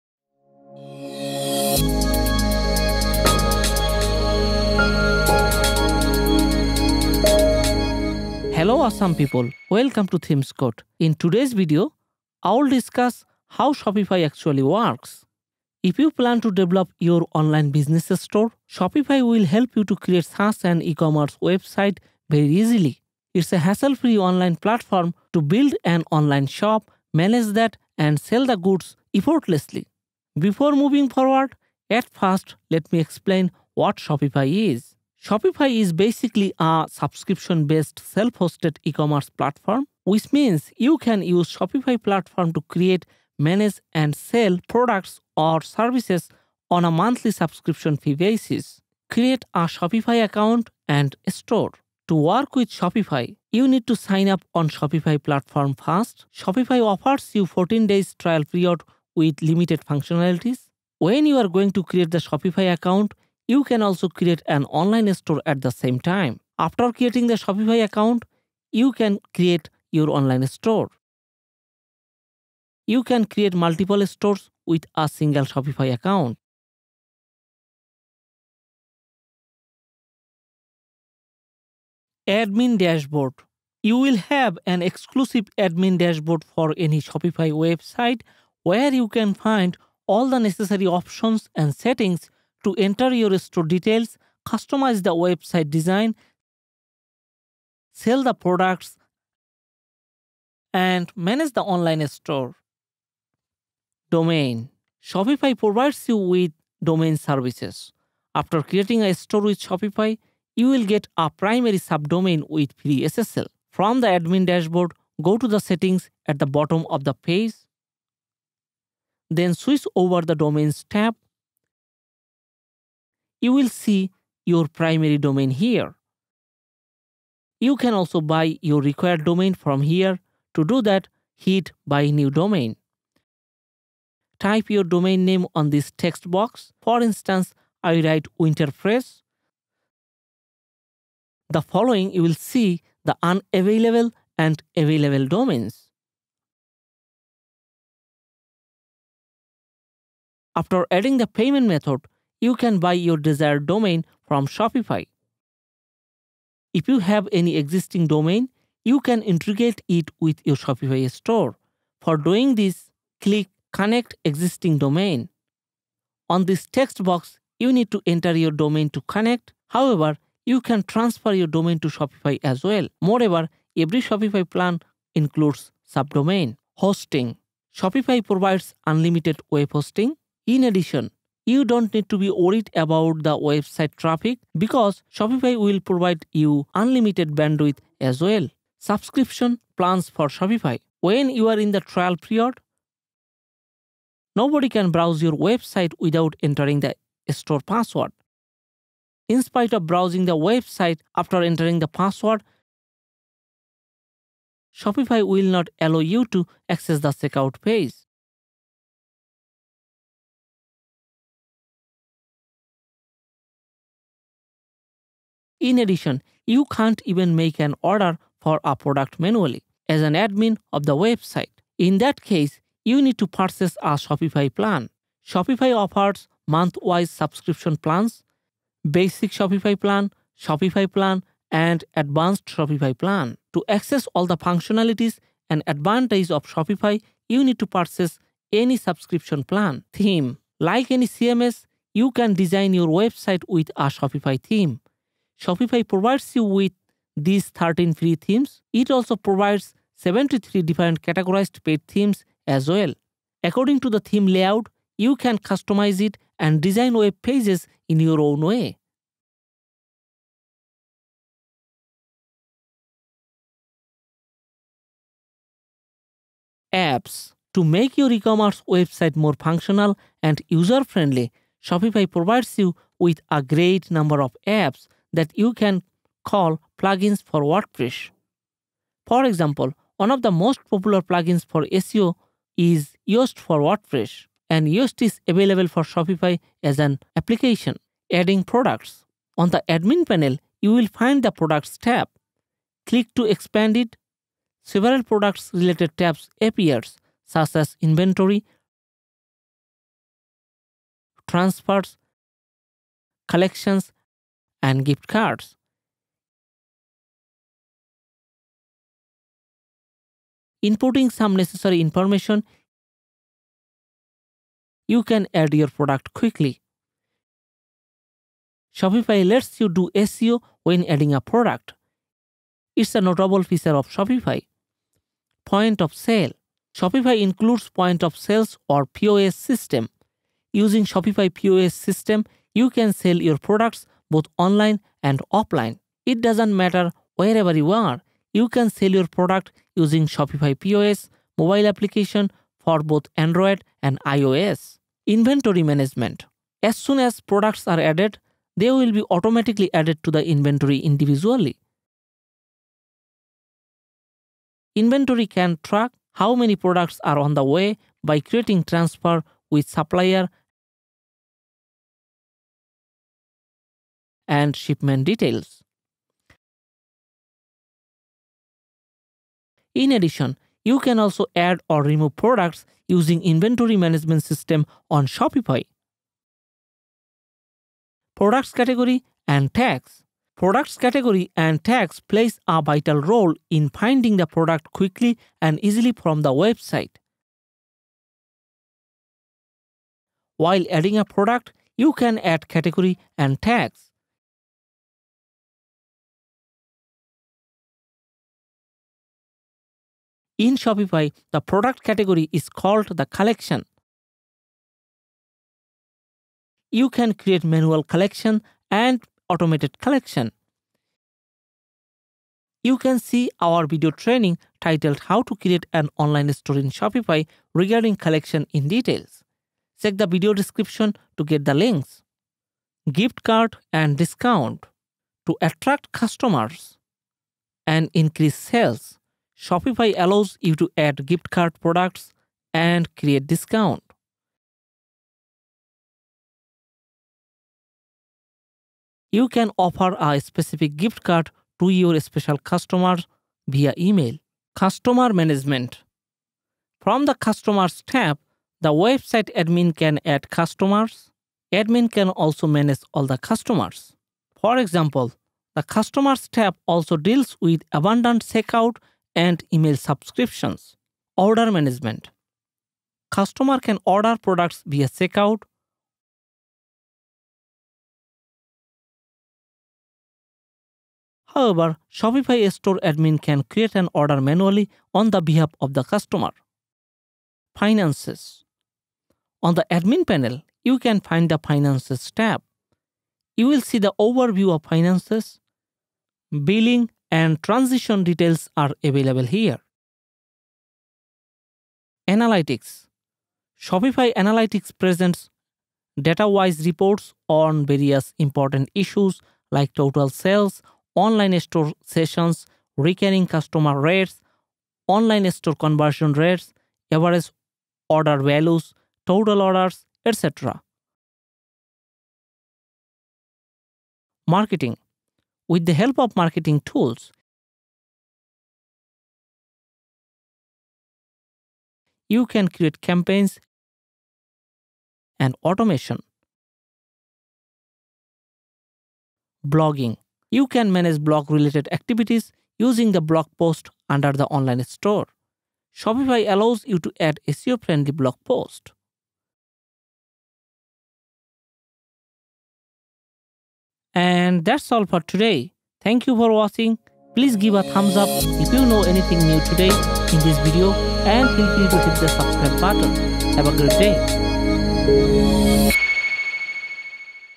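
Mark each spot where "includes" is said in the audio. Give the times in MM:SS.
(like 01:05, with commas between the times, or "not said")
02:55, 05:27.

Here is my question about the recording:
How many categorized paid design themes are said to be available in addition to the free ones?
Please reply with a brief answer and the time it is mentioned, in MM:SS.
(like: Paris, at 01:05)
73, at 04:09.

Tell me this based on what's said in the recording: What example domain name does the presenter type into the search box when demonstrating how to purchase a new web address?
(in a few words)
Winterpress.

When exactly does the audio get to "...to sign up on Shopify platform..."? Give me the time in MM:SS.
00:53.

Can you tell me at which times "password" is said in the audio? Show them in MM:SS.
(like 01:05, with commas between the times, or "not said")
03:17, 03:21.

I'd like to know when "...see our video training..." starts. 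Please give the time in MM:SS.
06:52.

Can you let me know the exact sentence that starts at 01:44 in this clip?
Domain Shopify provides you with domain services.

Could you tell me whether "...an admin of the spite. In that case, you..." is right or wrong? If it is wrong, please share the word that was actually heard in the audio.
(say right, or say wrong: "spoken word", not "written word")
wrong: "website", not "spite".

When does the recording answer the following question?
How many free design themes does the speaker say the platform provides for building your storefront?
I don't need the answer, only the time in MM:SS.
04:07.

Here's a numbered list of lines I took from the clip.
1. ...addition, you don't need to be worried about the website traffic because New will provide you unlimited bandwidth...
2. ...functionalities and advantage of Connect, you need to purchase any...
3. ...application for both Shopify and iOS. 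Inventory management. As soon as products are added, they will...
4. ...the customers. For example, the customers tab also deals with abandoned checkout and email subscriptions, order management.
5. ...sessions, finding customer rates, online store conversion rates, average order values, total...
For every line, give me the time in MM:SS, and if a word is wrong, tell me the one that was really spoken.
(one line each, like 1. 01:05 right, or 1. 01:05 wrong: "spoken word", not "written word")
1. 03:00 wrong: "Shopify", not "New"
2. 03:54 wrong: "Shopify", not "Connect"
3. 05:41 wrong: "Android", not "Shopify"
4. 07:33 right
5. 08:21 wrong: "recurring", not "finding".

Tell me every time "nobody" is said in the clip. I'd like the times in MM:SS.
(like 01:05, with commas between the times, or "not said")
03:14.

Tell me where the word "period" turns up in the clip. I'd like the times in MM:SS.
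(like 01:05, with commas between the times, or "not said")
00:58, 03:12.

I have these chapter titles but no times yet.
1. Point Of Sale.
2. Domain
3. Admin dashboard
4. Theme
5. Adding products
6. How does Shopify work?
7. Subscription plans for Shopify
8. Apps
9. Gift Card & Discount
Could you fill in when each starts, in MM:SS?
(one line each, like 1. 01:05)
1. 05:25
2. 01:43
3. 01:22
4. 04:00
5. 04:47
6. 00:50
7. 03:10
8. 04:27
9. 07:04.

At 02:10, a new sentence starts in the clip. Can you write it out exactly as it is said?
To do that, hit Buy New Domain.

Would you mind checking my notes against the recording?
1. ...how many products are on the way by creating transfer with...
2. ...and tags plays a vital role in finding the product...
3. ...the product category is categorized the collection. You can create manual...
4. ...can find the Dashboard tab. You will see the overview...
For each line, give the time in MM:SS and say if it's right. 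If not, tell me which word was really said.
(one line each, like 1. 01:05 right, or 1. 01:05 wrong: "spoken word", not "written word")
1. 05:56 right
2. 06:21 right
3. 06:41 wrong: "called", not "categorized"
4. 08:00 wrong: "Finances", not "Dashboard".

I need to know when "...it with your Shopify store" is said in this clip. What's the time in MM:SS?
02:39.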